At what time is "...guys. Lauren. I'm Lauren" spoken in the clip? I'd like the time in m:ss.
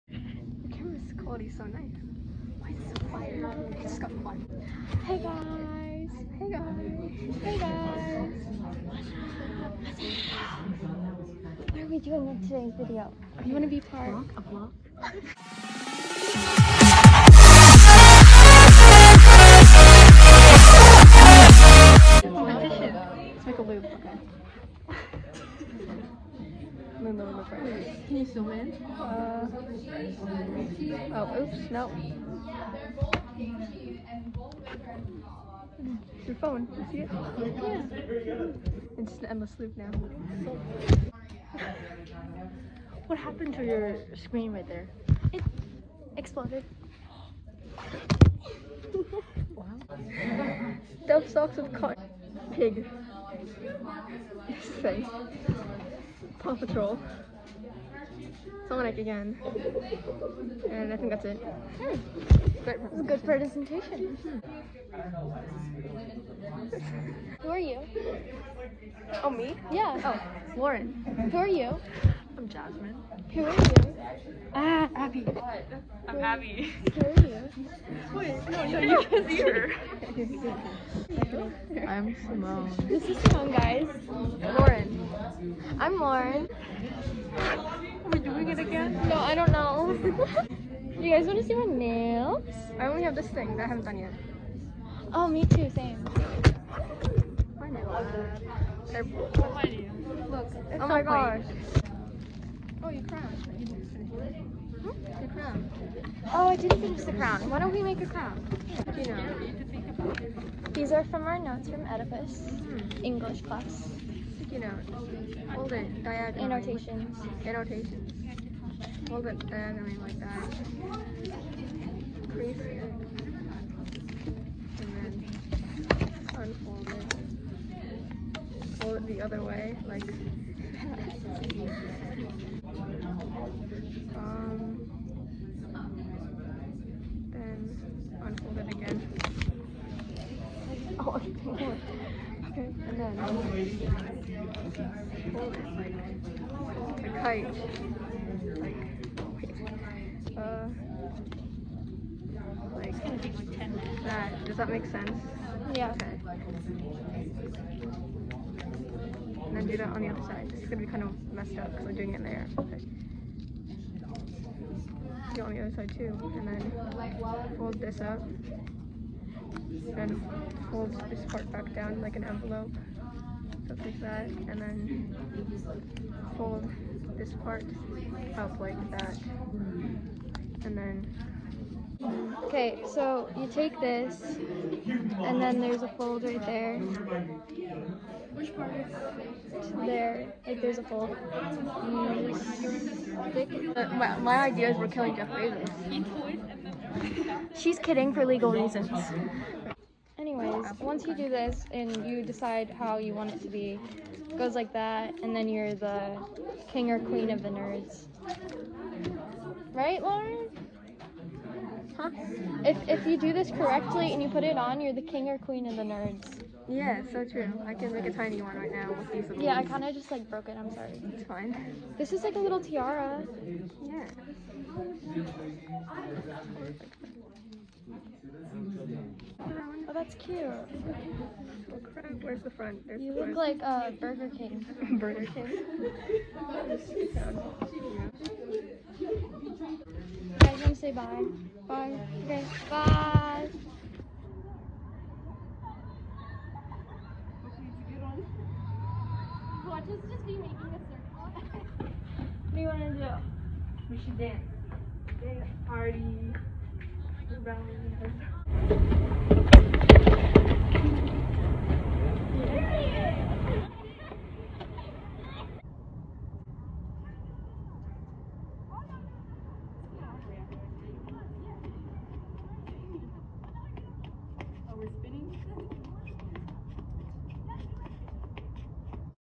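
1:23.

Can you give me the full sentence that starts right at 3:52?
There's you the look like uh, Burger King.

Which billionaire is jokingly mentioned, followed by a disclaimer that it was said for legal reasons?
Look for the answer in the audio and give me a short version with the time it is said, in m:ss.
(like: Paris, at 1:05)
Jeff Bezos, at 3:15.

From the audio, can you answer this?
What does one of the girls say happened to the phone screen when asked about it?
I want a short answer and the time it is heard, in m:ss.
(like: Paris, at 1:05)
It exploded, at 0:45.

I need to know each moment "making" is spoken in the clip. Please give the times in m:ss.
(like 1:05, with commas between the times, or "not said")
4:10.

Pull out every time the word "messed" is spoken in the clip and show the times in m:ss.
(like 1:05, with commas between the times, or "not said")
2:41.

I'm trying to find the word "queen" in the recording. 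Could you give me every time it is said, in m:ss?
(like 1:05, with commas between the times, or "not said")
3:26, 3:35.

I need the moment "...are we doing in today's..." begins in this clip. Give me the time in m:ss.
0:11.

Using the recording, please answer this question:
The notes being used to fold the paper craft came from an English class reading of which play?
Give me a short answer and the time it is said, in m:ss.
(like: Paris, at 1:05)
Oedipus, at 1:51.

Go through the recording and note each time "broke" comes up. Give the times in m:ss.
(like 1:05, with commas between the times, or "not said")
3:40.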